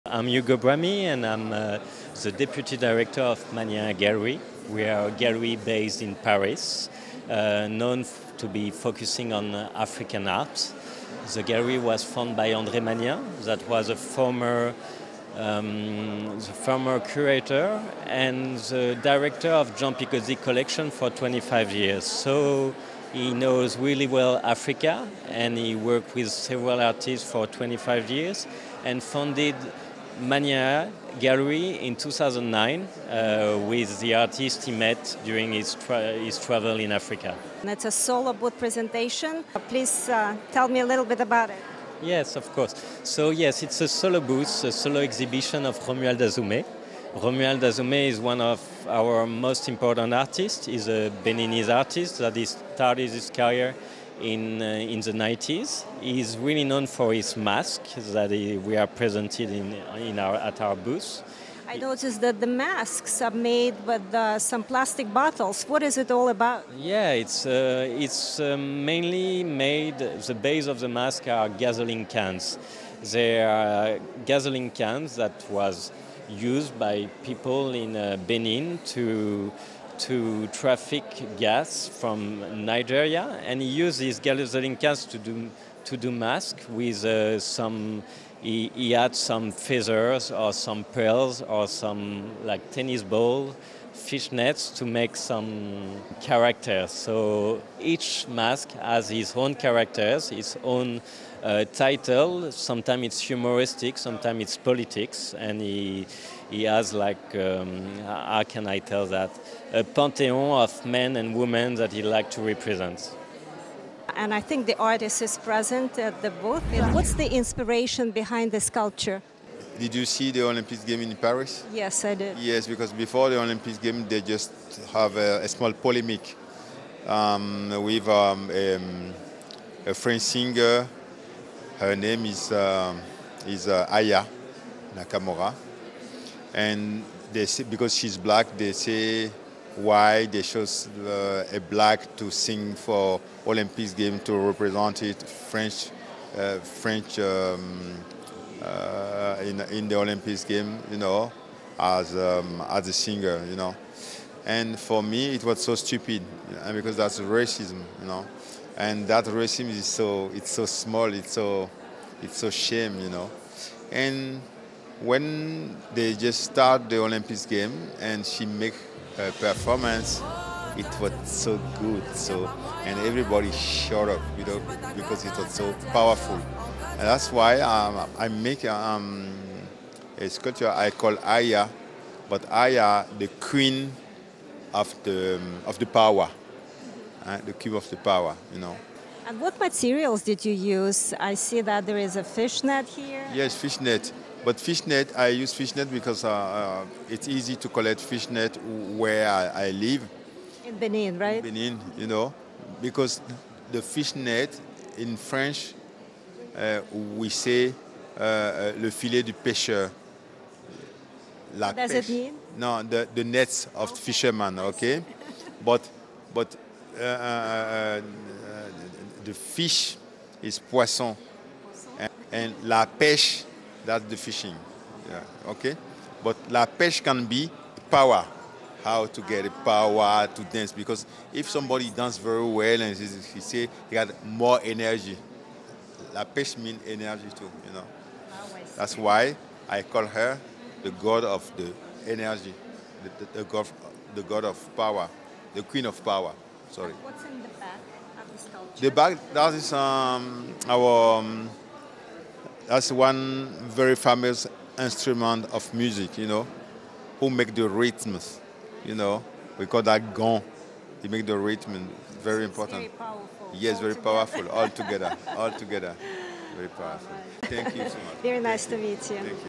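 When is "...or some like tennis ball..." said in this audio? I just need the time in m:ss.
1:31.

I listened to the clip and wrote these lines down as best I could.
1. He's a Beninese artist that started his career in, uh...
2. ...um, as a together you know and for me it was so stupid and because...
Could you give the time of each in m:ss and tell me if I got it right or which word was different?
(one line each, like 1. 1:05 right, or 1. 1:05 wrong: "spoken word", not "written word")
1. 0:50 right
2. 2:32 wrong: "singer", not "together".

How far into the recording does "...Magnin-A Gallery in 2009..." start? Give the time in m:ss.
0:30.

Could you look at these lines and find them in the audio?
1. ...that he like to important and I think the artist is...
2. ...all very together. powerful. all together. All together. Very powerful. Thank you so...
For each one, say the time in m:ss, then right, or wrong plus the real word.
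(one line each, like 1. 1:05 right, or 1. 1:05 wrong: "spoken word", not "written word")
1. 1:51 wrong: "represent", not "important"
2. 4:23 right.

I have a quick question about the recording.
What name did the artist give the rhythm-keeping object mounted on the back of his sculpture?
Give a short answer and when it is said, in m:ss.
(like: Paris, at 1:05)
Gong, at 4:20.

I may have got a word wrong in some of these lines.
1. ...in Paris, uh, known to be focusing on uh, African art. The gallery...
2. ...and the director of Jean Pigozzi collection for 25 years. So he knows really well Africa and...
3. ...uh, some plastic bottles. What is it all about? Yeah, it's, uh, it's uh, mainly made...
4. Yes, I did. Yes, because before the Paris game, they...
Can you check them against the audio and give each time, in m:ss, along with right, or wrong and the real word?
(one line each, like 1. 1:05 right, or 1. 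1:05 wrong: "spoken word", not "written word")
1. 0:06 right
2. 0:18 right
3. 1:04 right
4. 2:01 wrong: "Olympics", not "Paris".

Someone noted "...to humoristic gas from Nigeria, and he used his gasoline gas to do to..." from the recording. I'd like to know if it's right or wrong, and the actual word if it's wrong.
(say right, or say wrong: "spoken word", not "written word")
wrong: "traffic", not "humoristic".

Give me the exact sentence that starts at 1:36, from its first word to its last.
So each mask has his own characters, its own uh, title.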